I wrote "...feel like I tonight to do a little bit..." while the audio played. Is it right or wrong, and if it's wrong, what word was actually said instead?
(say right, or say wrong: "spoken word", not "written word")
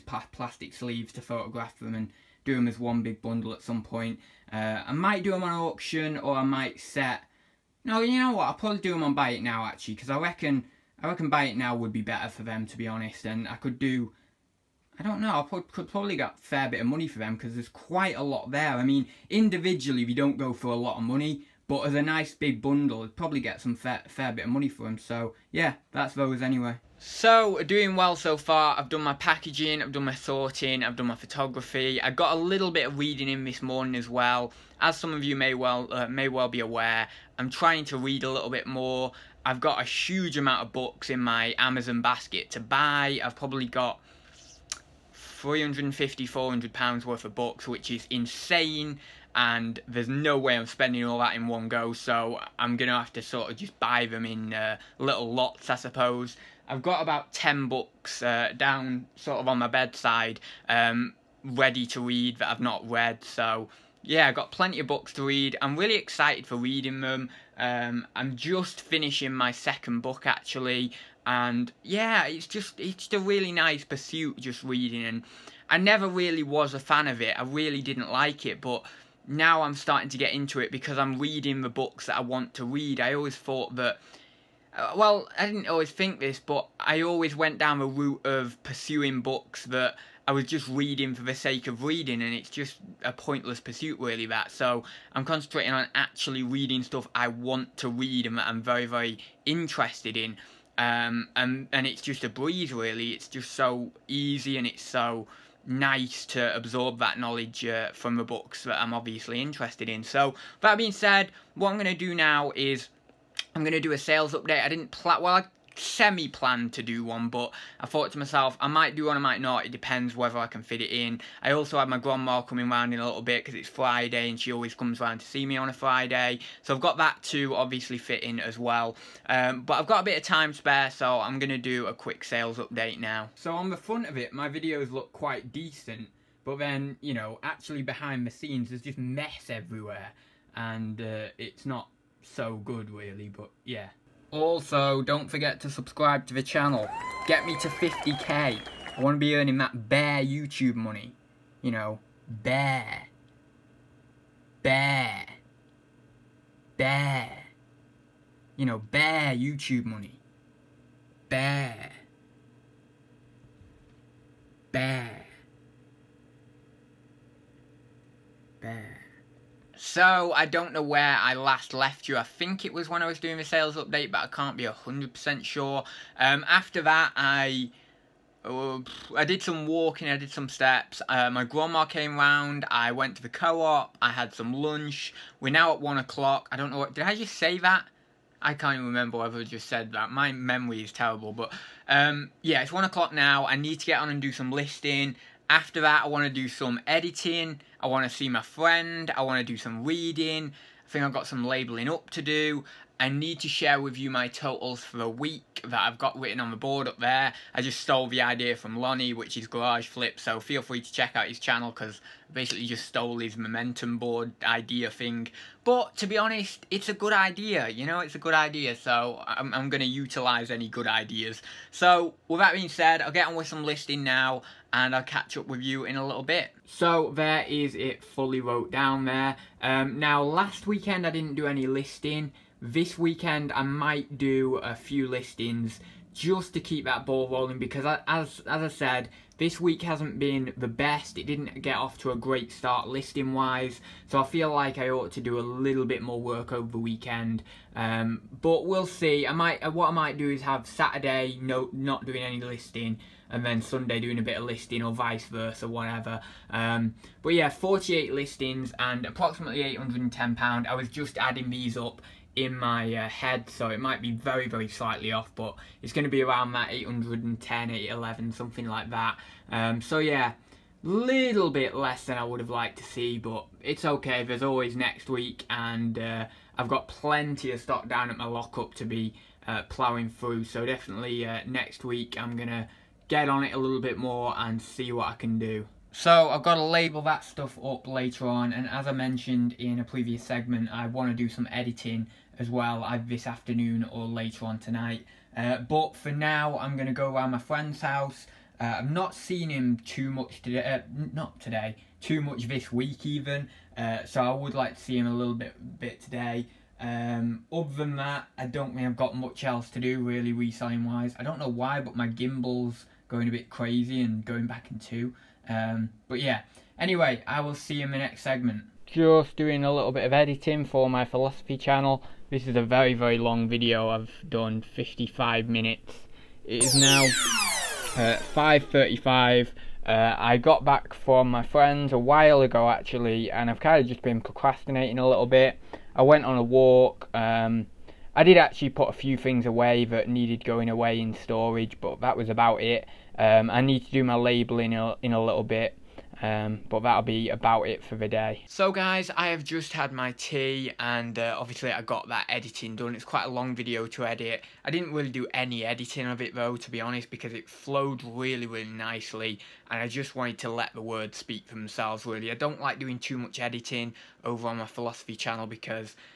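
wrong: "ought", not "tonight".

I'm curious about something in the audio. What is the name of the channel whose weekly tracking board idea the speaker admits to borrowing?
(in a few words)
Garage Flip.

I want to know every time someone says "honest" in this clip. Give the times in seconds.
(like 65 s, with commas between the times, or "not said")
12 s, 216 s, 356 s.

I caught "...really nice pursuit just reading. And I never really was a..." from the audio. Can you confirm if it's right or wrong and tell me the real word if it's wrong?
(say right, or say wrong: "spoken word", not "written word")
right.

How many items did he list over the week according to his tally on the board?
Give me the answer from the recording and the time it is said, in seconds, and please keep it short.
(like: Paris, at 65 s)
48, at 257 s.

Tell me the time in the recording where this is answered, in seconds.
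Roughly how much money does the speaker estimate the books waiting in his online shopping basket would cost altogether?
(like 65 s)
45 s.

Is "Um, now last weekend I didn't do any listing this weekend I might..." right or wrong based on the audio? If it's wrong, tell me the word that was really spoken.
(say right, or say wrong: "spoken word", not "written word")
right.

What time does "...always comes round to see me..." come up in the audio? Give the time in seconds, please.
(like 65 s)
124 s.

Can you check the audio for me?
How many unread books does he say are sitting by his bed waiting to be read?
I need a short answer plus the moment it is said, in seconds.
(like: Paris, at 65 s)
10, at 57 s.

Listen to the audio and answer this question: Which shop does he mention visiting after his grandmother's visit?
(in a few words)
co-op.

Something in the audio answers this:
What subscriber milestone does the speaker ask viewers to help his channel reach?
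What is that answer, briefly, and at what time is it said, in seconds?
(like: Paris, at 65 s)
50k, at 147 s.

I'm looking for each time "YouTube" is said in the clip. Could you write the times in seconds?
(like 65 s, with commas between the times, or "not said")
150 s, 159 s.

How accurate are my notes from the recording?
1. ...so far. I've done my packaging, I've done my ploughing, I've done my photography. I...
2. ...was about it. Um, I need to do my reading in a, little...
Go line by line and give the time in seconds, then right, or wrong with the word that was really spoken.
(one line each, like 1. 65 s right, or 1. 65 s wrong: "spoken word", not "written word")
1. 28 s wrong: "sorting", not "ploughing"
2. 342 s wrong: "labelling", not "reading".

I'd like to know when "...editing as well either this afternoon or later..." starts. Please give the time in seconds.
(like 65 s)
291 s.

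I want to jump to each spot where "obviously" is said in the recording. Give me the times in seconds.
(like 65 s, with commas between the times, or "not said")
108 s, 127 s, 351 s.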